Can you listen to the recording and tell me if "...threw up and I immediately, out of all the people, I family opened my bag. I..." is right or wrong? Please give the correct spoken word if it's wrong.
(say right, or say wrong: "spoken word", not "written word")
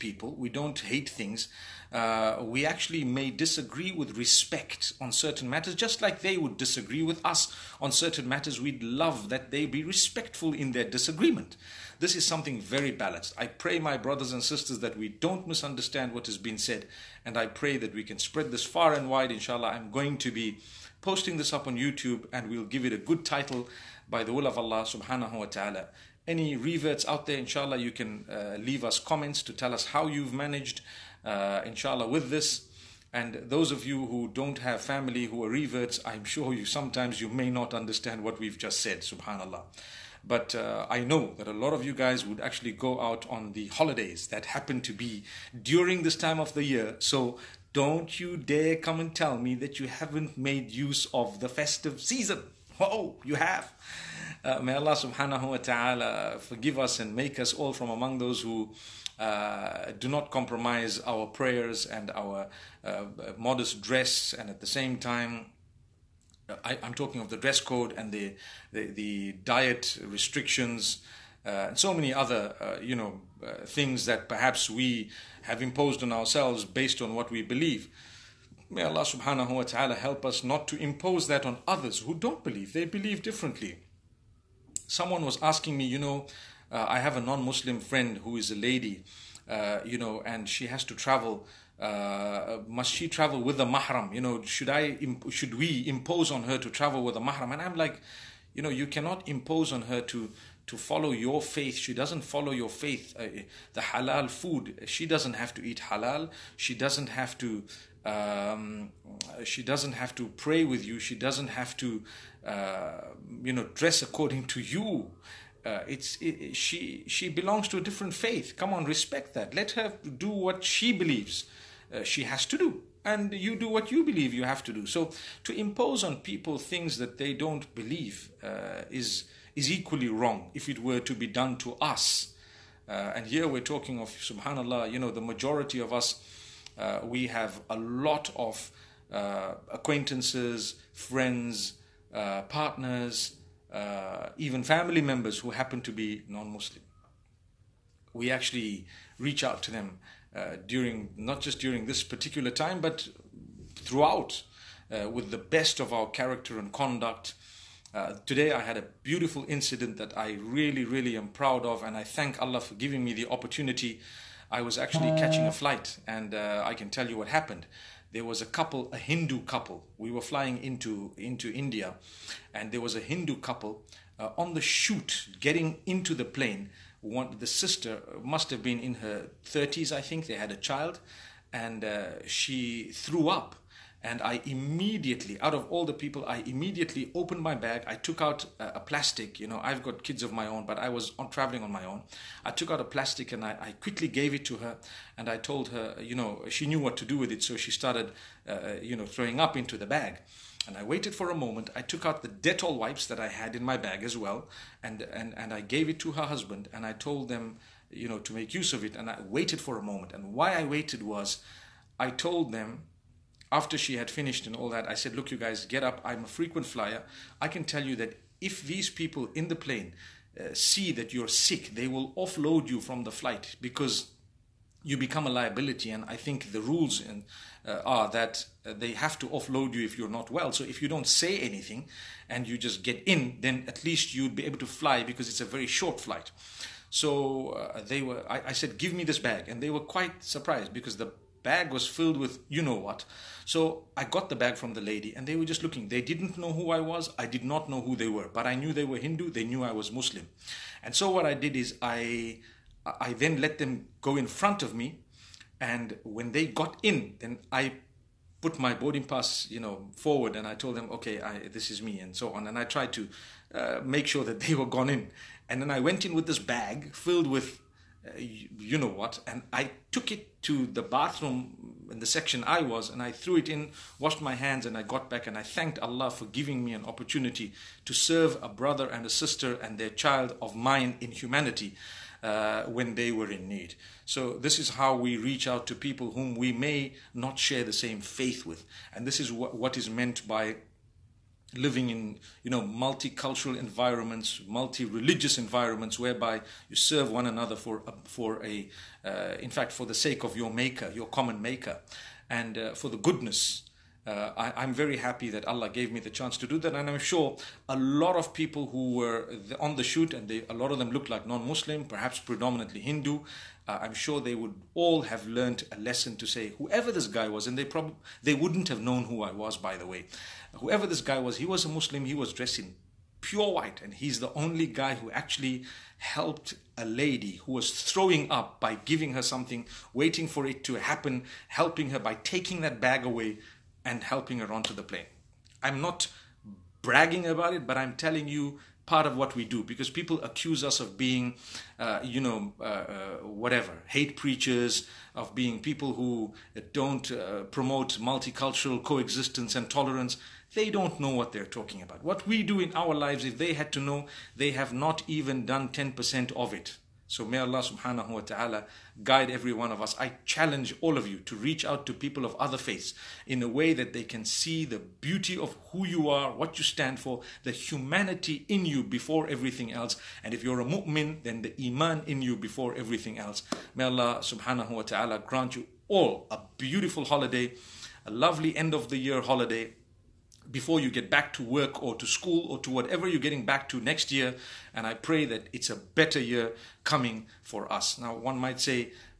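wrong: "immediately", not "family".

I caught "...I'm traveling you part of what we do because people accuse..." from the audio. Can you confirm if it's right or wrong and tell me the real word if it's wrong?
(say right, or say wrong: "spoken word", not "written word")
wrong: "telling", not "traveling".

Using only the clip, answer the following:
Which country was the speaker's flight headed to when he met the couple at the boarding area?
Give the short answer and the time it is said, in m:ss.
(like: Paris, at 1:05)
India, at 2:51.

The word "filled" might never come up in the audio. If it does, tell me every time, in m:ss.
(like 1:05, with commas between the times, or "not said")
4:01, 4:26.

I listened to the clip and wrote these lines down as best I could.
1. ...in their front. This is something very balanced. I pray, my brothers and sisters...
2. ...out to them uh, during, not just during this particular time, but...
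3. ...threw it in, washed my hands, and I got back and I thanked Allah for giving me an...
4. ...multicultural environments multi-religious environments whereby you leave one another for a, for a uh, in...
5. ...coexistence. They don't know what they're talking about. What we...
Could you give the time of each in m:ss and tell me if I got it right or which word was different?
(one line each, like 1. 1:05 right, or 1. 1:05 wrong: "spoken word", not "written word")
1. 0:10 wrong: "disagreement", not "front"
2. 2:29 right
3. 4:33 right
4. 4:52 wrong: "serve", not "leave"
5. 5:49 wrong: "tolerance", not "coexistence".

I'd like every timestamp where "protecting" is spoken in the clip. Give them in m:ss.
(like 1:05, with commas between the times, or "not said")
not said.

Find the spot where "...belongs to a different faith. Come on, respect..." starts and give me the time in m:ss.
1:57.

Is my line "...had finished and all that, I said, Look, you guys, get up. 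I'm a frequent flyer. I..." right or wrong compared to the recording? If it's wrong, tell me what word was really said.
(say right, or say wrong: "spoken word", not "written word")
right.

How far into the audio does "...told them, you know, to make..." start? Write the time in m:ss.
3:26.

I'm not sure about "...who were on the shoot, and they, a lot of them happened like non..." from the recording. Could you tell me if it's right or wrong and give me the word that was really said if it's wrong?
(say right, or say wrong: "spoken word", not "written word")
wrong: "looked", not "happened".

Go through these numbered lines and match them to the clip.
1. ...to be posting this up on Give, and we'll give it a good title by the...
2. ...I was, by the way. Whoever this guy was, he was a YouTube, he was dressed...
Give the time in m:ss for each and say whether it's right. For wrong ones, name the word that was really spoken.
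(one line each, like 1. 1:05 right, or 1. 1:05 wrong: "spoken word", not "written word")
1. 0:20 wrong: "YouTube", not "Give"
2. 5:19 wrong: "Muslim", not "YouTube".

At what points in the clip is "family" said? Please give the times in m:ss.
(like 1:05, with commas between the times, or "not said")
0:34, 2:24.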